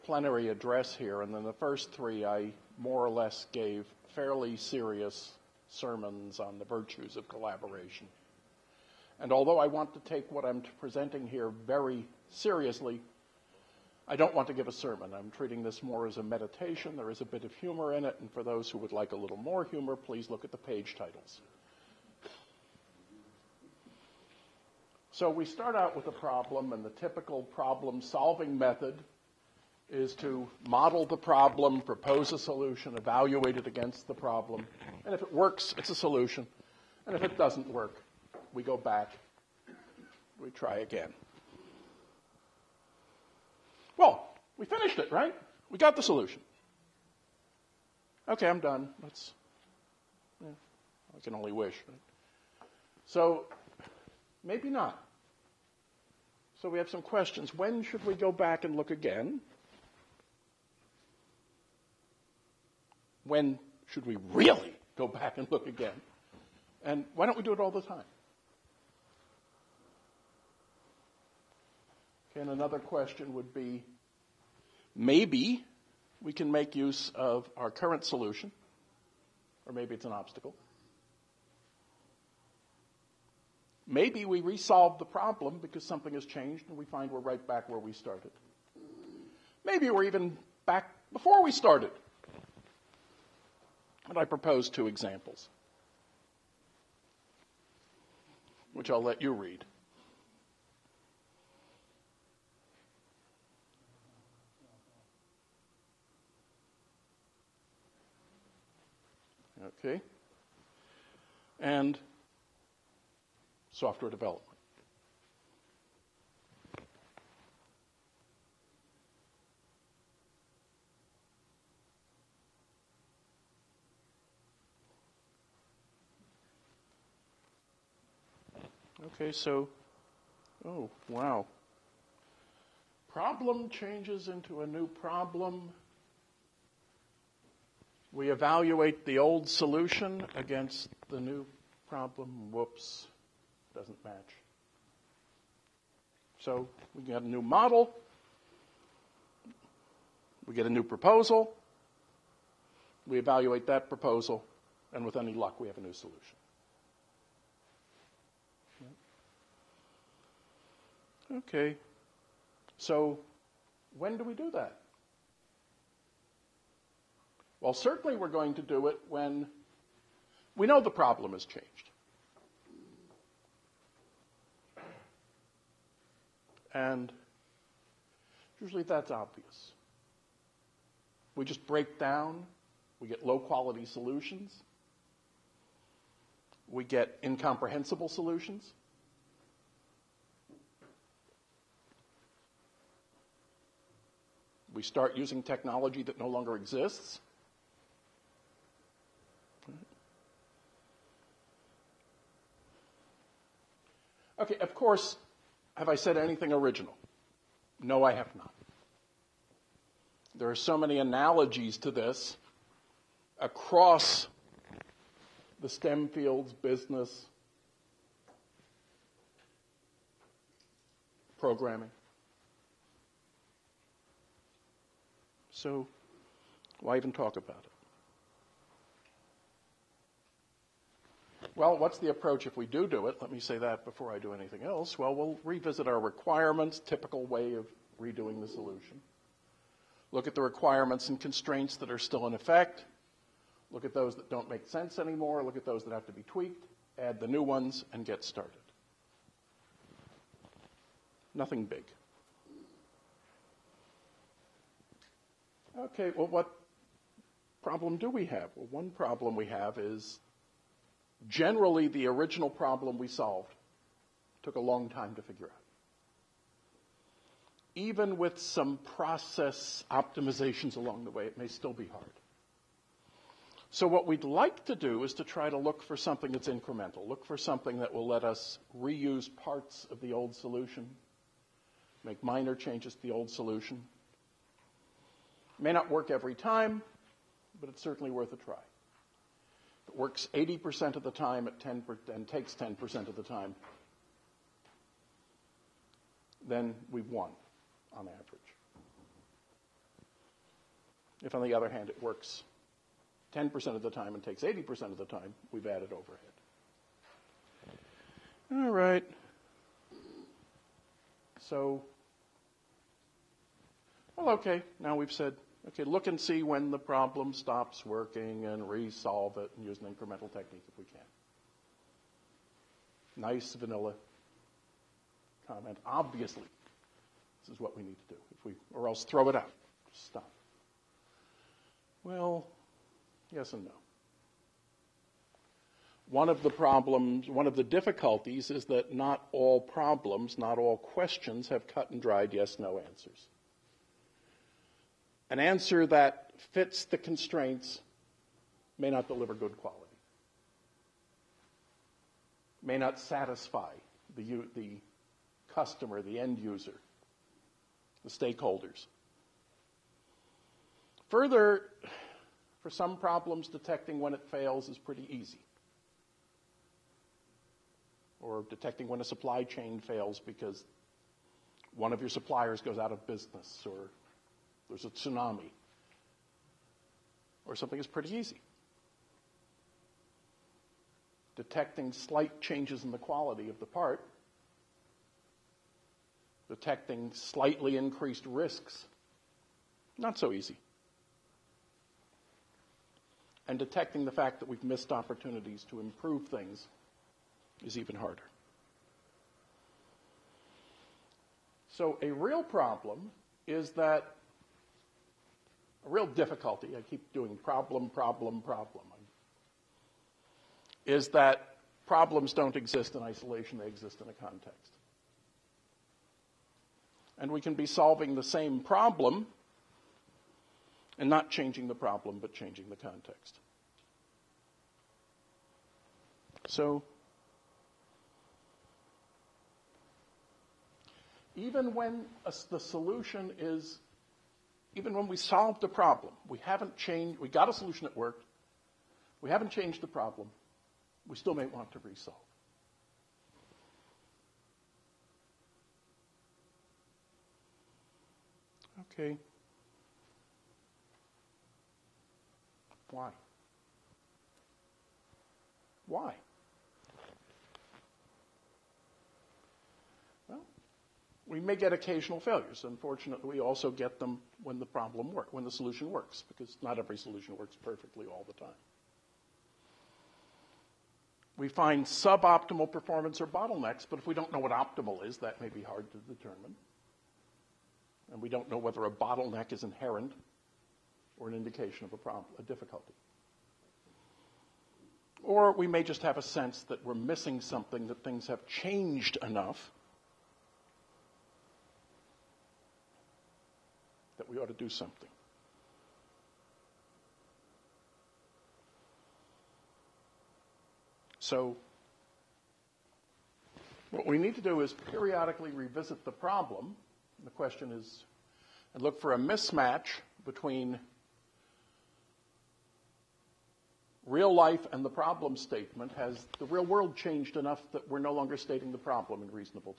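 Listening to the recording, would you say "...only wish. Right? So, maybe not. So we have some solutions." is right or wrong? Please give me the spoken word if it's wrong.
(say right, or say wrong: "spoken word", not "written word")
wrong: "questions", not "solutions".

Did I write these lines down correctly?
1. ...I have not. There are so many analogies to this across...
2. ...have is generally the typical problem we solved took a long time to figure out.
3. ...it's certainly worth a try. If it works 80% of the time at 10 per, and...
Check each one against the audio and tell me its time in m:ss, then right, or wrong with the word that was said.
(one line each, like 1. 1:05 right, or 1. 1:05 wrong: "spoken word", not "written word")
1. 3:28 right
2. 4:19 wrong: "original", not "typical"
3. 4:47 right.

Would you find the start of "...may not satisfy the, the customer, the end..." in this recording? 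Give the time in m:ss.
5:52.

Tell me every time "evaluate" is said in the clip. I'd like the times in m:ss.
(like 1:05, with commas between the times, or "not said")
0:32, 2:18, 2:33.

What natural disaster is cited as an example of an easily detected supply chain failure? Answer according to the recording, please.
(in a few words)
A tsunami.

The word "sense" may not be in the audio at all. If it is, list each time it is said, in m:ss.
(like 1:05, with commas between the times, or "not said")
4:04, 8:06.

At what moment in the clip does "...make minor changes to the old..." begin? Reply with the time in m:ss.
4:42.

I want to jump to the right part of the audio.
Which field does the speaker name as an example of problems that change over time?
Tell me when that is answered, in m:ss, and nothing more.
1:53.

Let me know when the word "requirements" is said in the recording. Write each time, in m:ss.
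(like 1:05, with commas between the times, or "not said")
3:55, 4:00.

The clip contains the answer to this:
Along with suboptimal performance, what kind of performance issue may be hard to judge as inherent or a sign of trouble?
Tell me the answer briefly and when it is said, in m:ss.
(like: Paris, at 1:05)
Bottlenecks, at 7:53.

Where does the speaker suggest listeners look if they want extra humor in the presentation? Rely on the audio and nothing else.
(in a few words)
The page titles.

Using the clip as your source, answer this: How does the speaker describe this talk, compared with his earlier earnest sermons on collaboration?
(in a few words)
A meditation.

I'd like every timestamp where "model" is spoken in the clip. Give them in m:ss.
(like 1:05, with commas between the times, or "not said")
0:30, 2:27.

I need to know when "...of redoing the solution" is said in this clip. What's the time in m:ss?
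3:57.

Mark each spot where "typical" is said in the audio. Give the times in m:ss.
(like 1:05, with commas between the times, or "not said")
0:26, 3:56.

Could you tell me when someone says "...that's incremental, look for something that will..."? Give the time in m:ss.
4:36.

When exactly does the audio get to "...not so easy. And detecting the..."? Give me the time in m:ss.
6:29.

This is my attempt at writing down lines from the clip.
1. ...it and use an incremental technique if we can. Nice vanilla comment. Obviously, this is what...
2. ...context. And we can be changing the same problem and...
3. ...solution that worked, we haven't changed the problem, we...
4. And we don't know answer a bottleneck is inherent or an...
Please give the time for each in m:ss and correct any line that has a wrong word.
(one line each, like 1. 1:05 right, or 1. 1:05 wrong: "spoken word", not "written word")
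1. 5:19 right
2. 6:54 wrong: "solving", not "changing"
3. 7:17 right
4. 7:58 wrong: "whether", not "answer".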